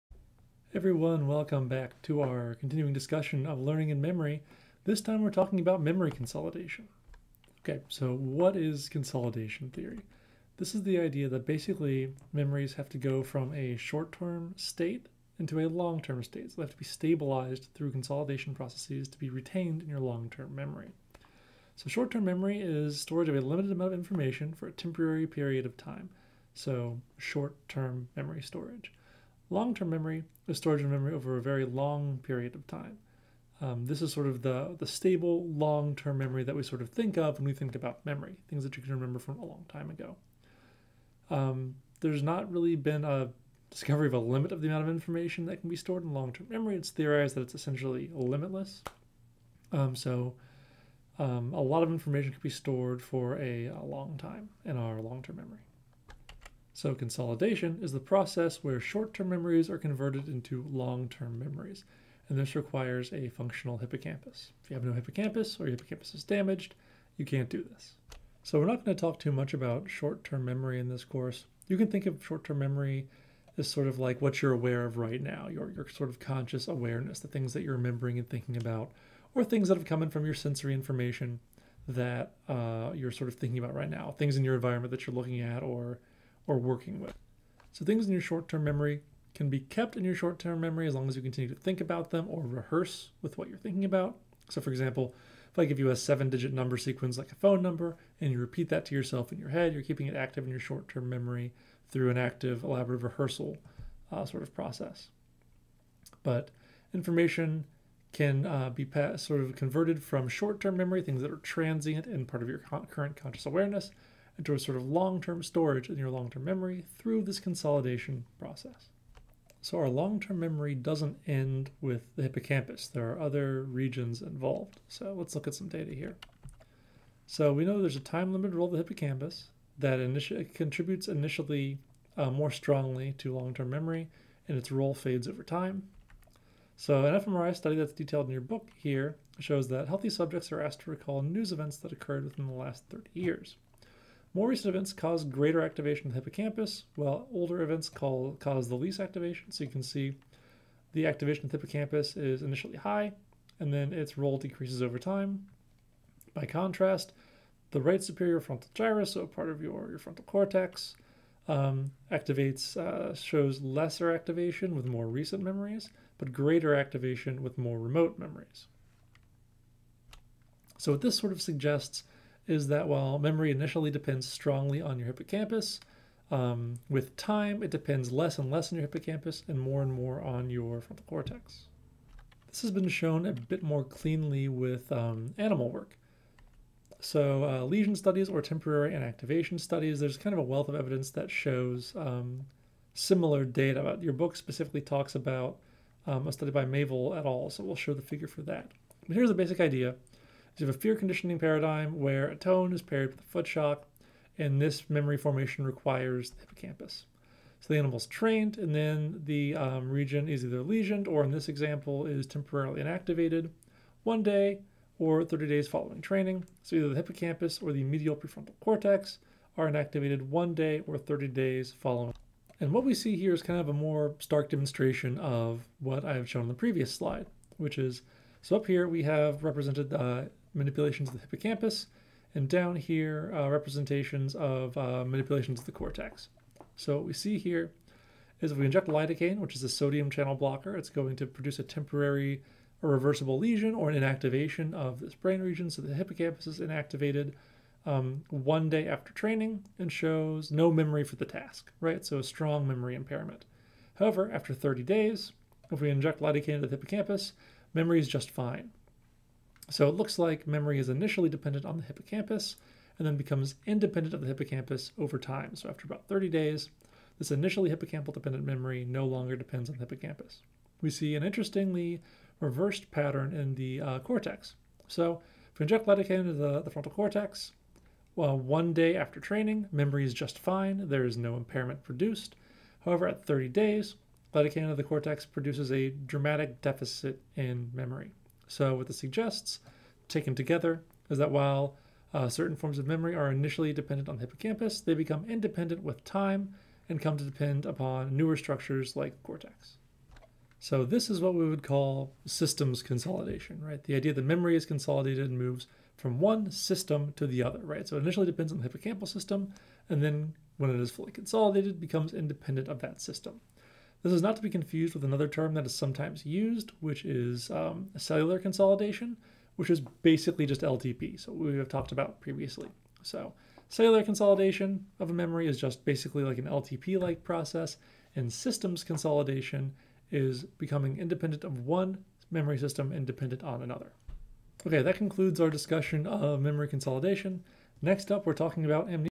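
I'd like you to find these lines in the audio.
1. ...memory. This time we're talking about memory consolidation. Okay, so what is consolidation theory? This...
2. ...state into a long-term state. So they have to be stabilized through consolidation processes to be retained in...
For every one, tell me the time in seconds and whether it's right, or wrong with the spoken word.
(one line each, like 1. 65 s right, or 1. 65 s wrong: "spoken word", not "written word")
1. 4 s right
2. 14 s right.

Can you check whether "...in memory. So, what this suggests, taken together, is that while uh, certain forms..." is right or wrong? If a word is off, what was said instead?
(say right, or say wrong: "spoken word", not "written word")
right.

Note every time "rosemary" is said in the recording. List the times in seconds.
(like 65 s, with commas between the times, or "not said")
not said.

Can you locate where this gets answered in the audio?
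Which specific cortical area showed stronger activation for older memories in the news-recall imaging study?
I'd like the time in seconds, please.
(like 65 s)
157 s.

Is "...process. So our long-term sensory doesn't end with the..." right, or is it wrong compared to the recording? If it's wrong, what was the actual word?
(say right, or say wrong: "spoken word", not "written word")
wrong: "memory", not "sensory".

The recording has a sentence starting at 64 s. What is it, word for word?
If you have no hippocampus or your hippocampus is damaged, you can't do this.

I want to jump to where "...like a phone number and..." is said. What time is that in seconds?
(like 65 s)
97 s.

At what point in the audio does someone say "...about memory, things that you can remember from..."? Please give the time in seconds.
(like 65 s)
37 s.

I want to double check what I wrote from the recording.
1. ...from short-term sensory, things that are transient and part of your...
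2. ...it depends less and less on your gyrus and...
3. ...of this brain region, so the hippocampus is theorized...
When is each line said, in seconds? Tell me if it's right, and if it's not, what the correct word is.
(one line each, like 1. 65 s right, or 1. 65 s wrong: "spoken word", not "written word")
1. 110 s wrong: "memory", not "sensory"
2. 177 s wrong: "hippocampus", not "gyrus"
3. 244 s wrong: "inactivated", not "theorized".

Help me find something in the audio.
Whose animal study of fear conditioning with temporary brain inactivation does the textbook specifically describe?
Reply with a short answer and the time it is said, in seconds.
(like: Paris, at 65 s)
Maviel et al., at 196 s.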